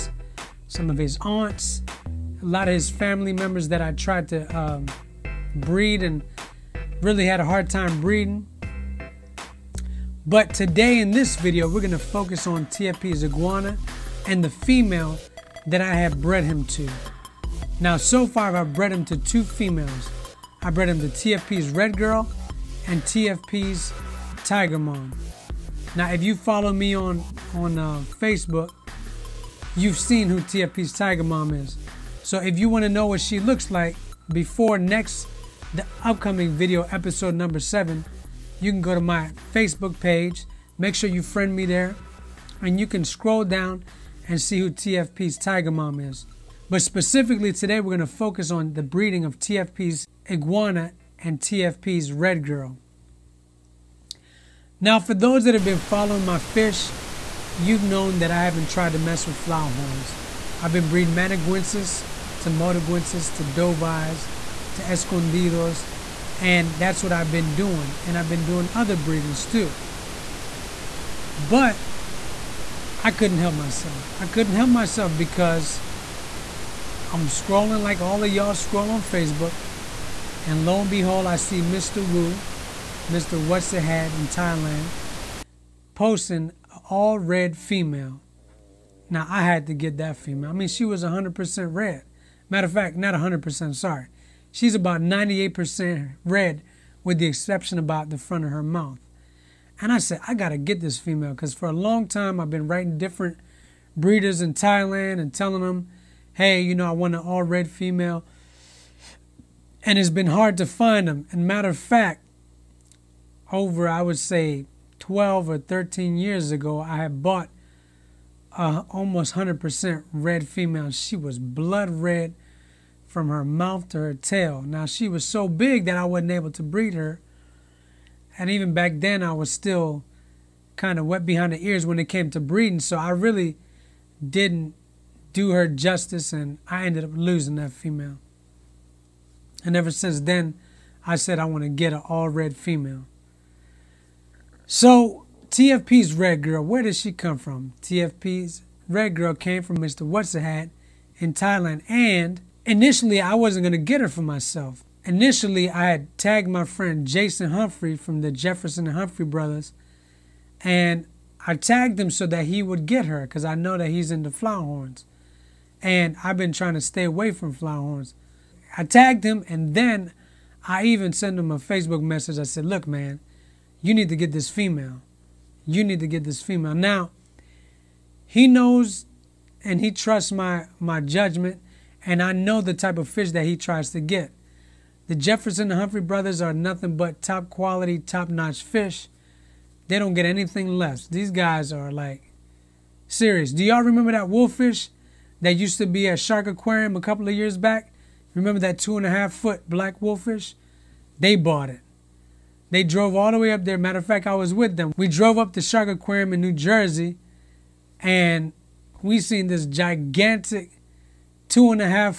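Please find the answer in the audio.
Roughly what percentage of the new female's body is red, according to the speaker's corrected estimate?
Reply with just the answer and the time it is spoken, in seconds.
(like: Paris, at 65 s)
98%, at 94 s.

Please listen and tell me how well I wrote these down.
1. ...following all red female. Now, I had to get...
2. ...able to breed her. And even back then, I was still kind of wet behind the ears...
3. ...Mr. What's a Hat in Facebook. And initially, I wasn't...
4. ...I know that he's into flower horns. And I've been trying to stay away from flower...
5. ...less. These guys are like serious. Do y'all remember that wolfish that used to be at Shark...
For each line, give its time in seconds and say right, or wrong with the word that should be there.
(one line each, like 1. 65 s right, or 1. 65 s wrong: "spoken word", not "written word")
1. 85 s wrong: "posting", not "following"
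2. 126 s right
3. 149 s wrong: "Thailand", not "Facebook"
4. 163 s right
5. 190 s right.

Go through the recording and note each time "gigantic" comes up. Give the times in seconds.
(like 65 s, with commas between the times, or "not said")
209 s.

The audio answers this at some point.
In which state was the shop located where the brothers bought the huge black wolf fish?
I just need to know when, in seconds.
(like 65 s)
206 s.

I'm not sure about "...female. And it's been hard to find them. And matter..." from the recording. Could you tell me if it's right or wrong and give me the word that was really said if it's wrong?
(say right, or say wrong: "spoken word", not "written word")
right.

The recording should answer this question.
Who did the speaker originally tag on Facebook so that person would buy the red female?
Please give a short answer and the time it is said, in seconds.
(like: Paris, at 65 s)
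Jason Humphrey, at 157 s.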